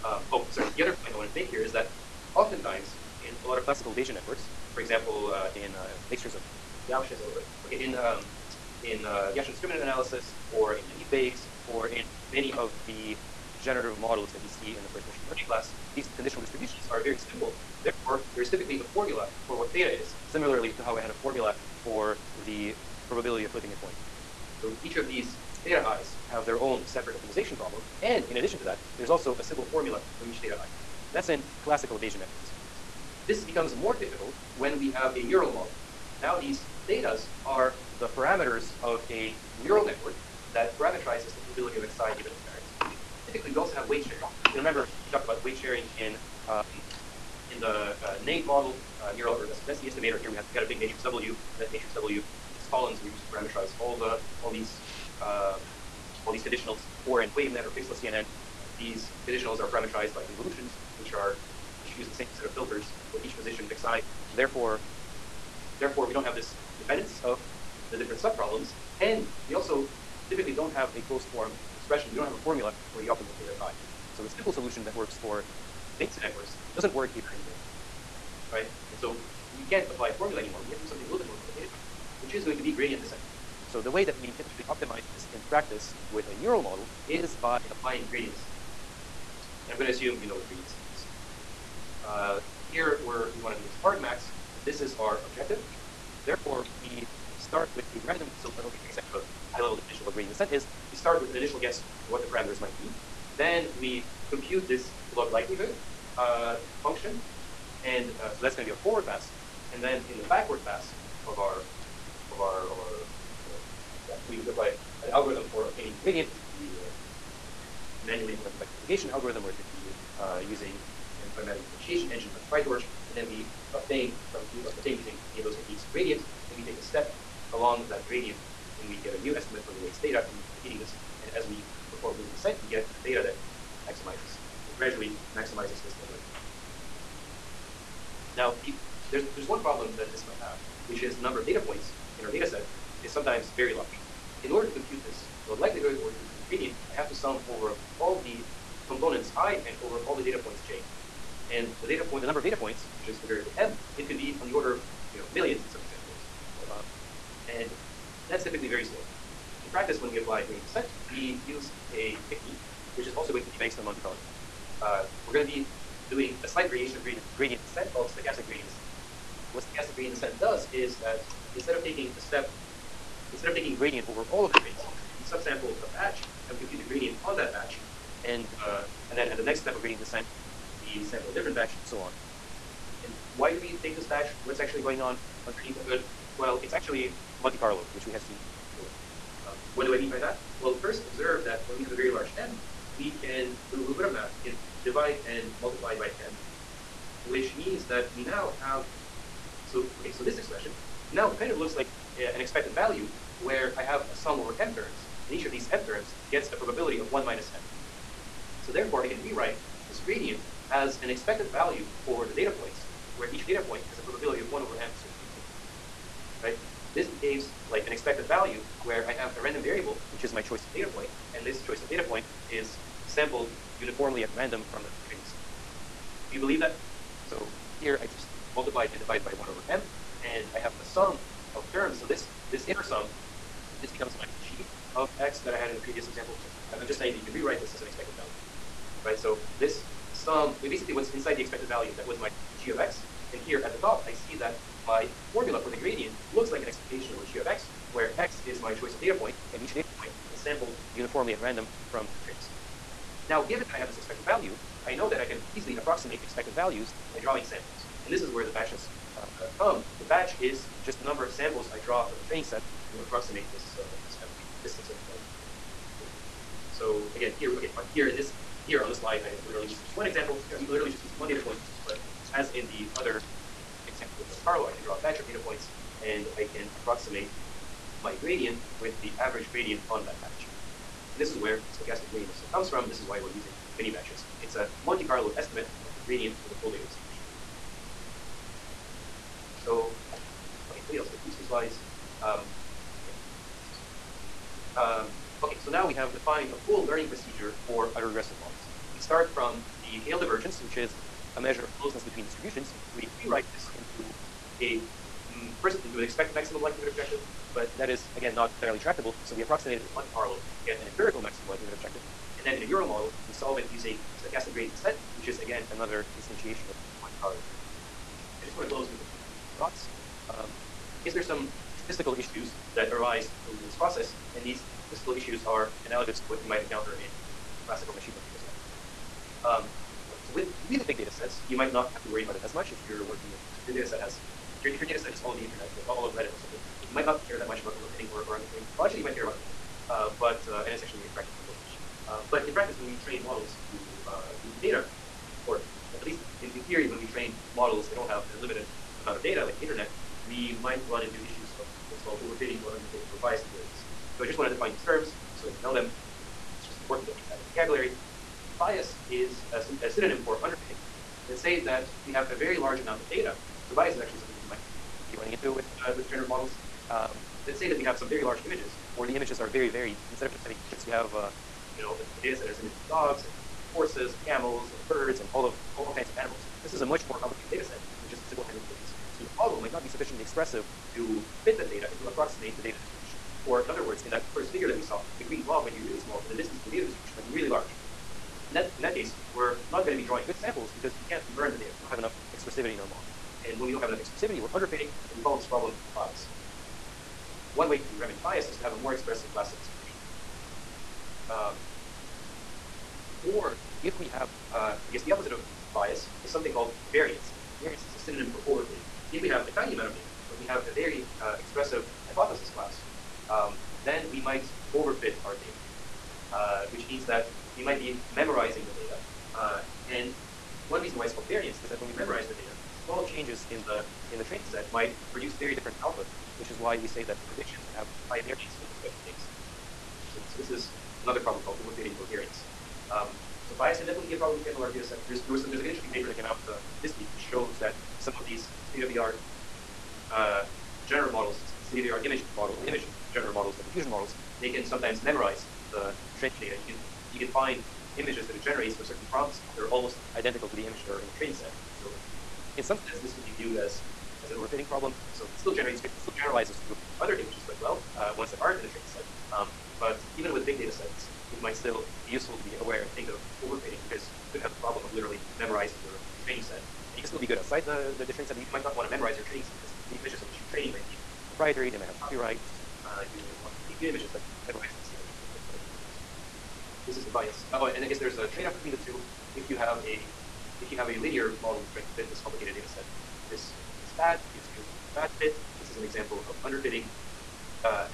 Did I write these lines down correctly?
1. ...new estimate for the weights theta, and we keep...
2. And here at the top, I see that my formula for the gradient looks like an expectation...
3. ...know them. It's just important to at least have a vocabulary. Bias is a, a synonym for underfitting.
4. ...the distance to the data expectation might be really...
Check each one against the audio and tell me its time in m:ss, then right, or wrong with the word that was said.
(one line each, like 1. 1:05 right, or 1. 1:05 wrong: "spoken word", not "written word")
1. 2:09 right
2. 4:03 right
3. 5:55 right
4. 6:26 wrong: "distribution", not "expectation".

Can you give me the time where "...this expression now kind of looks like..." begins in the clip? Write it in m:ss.
3:20.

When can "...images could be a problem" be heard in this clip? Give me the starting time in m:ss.
7:54.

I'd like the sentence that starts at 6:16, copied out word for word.
This is a much more complicated data set than just simple handwritten images.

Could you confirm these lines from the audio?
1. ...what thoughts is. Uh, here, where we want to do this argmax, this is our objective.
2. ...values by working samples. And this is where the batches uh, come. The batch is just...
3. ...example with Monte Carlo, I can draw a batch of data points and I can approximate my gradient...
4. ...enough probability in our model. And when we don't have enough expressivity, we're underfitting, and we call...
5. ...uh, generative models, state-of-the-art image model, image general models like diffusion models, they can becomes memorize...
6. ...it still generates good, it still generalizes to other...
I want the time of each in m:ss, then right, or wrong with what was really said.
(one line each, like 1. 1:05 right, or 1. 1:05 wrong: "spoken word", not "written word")
1. 1:30 wrong: "gradients", not "thoughts"
2. 4:16 wrong: "drawing", not "working"
3. 4:33 right
4. 6:31 wrong: "expressivity", not "probability"
5. 7:20 wrong: "sometimes", not "becomes"
6. 7:35 right.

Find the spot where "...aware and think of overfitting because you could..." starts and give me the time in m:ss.
7:42.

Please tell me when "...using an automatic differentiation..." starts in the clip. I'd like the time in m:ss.
2:00.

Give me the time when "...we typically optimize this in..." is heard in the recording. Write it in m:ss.
1:24.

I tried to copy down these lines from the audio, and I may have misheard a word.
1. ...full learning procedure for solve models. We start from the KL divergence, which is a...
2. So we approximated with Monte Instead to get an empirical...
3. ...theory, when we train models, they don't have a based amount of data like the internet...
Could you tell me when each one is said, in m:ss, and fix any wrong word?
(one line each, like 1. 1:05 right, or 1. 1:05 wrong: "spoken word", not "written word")
1. 4:56 wrong: "autoregressive", not "solve"
2. 5:09 wrong: "Carlo", not "Instead"
3. 5:46 wrong: "limited", not "based".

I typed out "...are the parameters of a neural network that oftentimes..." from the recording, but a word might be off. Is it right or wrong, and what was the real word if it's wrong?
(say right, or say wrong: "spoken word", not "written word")
wrong: "parameterizes", not "oftentimes".